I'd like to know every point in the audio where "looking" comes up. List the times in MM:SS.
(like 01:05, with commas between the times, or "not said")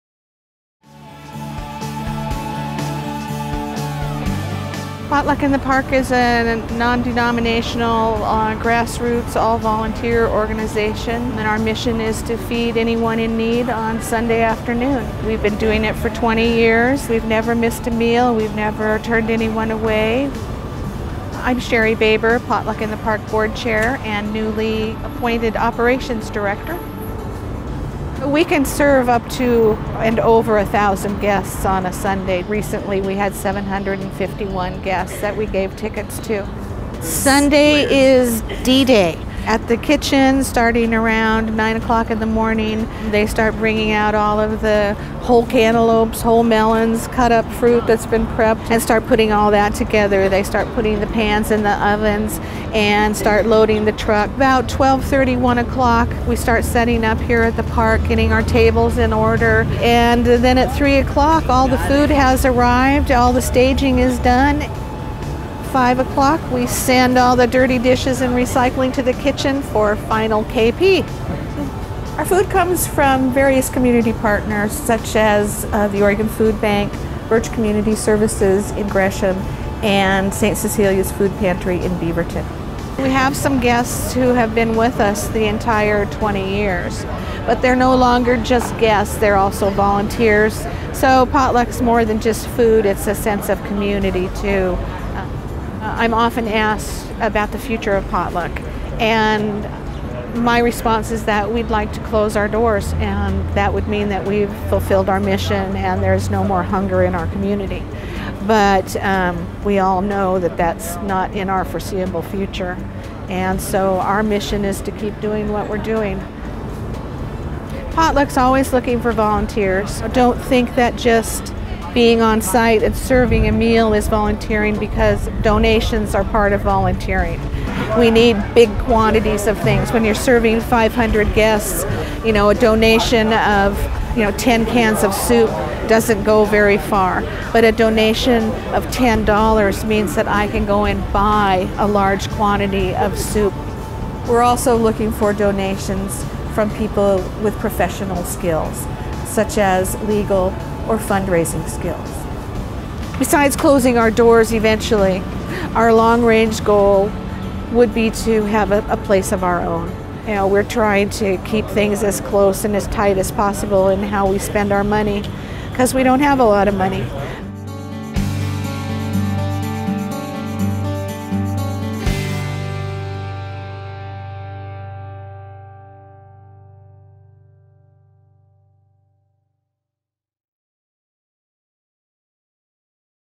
01:58, 02:24.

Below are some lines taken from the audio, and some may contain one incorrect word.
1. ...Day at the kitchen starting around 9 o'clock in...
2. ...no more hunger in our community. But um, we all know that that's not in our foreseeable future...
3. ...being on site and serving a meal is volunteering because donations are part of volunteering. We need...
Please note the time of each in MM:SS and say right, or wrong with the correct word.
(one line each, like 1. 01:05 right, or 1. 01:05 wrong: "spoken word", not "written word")
1. 00:38 right
2. 01:46 right
3. 02:01 right.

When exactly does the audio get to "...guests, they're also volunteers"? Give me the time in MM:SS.
01:28.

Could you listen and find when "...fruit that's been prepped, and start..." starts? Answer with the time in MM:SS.
00:47.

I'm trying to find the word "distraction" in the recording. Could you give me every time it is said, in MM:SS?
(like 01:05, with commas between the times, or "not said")
not said.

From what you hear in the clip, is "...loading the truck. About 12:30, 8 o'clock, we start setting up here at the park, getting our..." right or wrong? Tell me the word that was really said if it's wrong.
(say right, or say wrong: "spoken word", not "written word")
wrong: "1", not "8".